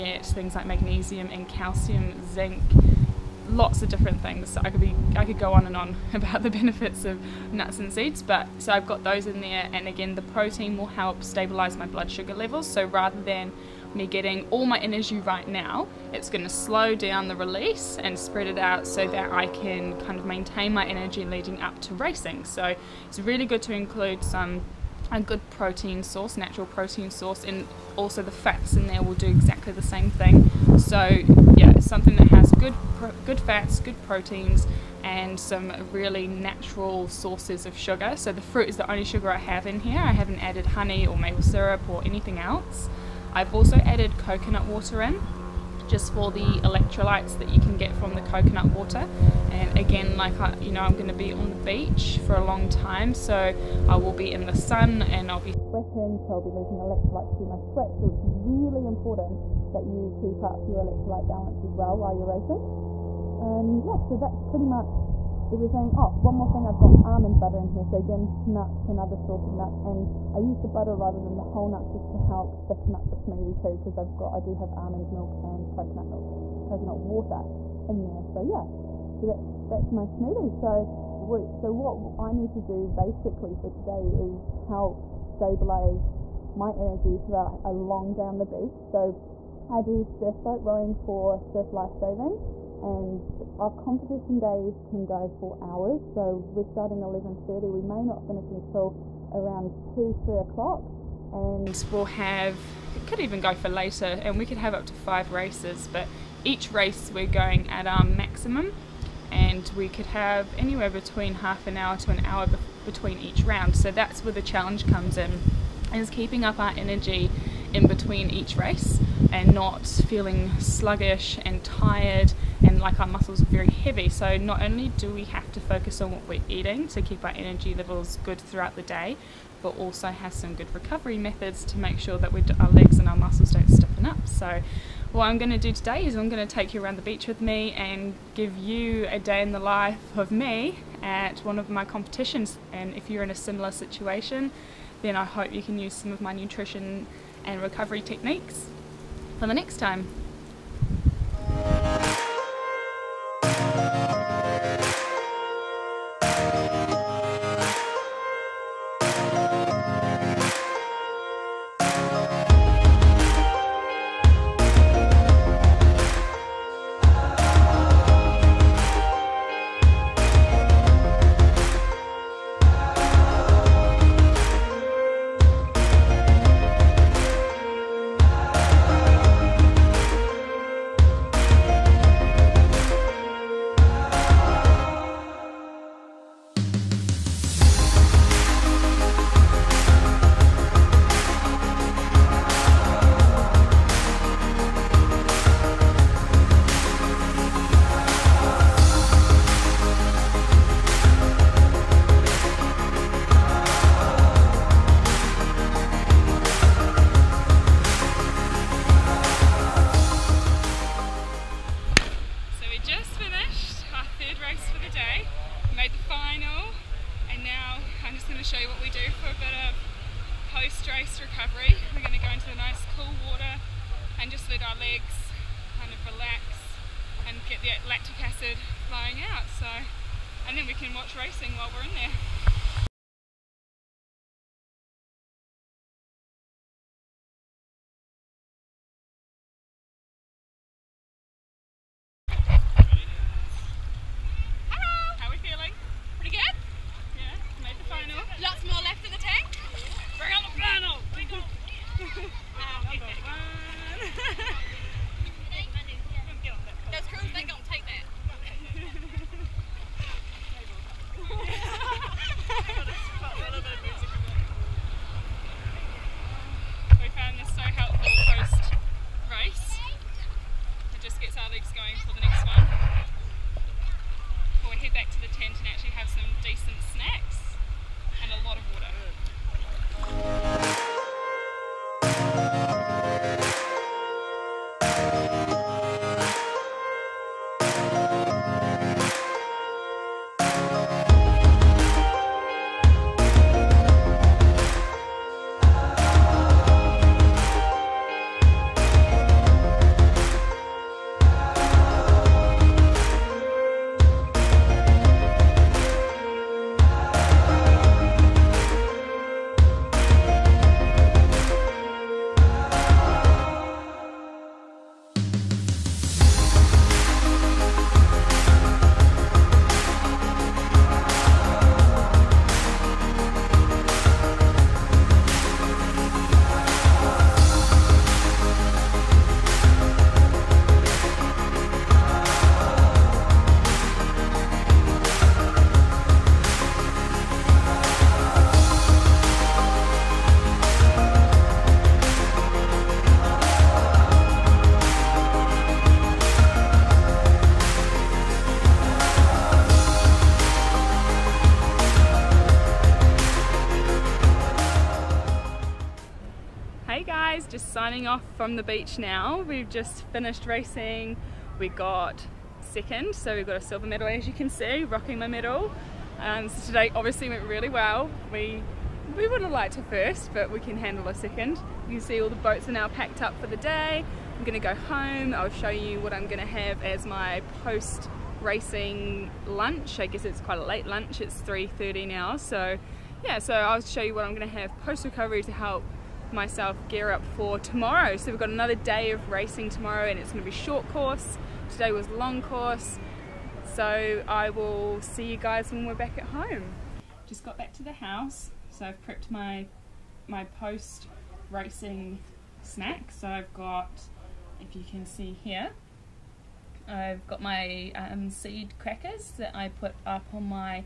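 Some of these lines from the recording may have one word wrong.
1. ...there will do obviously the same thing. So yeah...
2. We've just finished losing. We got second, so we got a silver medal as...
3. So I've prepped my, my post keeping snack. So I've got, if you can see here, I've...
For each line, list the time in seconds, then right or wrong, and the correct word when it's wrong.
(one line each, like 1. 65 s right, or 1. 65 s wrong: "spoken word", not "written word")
1. 28 s wrong: "exactly", not "obviously"
2. 359 s wrong: "racing", not "losing"
3. 398 s wrong: "racing", not "keeping".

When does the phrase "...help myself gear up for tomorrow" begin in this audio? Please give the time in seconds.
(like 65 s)
385 s.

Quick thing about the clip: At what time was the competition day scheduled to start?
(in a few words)
11:30.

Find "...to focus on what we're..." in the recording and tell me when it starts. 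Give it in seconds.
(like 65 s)
125 s.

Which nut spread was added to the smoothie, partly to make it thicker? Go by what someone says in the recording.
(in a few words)
Almond butter.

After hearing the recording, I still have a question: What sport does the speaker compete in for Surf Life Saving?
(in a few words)
Surf boat rowing.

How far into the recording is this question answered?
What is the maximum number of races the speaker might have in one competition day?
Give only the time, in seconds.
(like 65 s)
104 s.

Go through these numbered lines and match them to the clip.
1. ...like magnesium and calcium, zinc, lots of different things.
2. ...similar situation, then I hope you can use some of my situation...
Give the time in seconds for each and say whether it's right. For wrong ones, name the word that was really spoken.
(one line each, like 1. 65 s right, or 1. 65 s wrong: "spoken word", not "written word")
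1. 0 s right
2. 143 s wrong: "nutrition", not "situation".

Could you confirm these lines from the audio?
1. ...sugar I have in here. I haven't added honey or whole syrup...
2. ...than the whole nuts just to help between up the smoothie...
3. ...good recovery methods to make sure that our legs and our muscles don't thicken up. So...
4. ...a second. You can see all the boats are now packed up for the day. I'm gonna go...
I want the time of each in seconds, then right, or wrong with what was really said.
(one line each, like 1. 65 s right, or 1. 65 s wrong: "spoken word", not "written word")
1. 39 s wrong: "maple", not "whole"
2. 71 s wrong: "thicken", not "between"
3. 130 s wrong: "stiffen", not "thicken"
4. 371 s right.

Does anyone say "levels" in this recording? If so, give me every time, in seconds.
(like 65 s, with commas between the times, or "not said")
12 s, 127 s.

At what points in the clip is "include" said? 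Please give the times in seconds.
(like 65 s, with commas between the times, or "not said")
23 s.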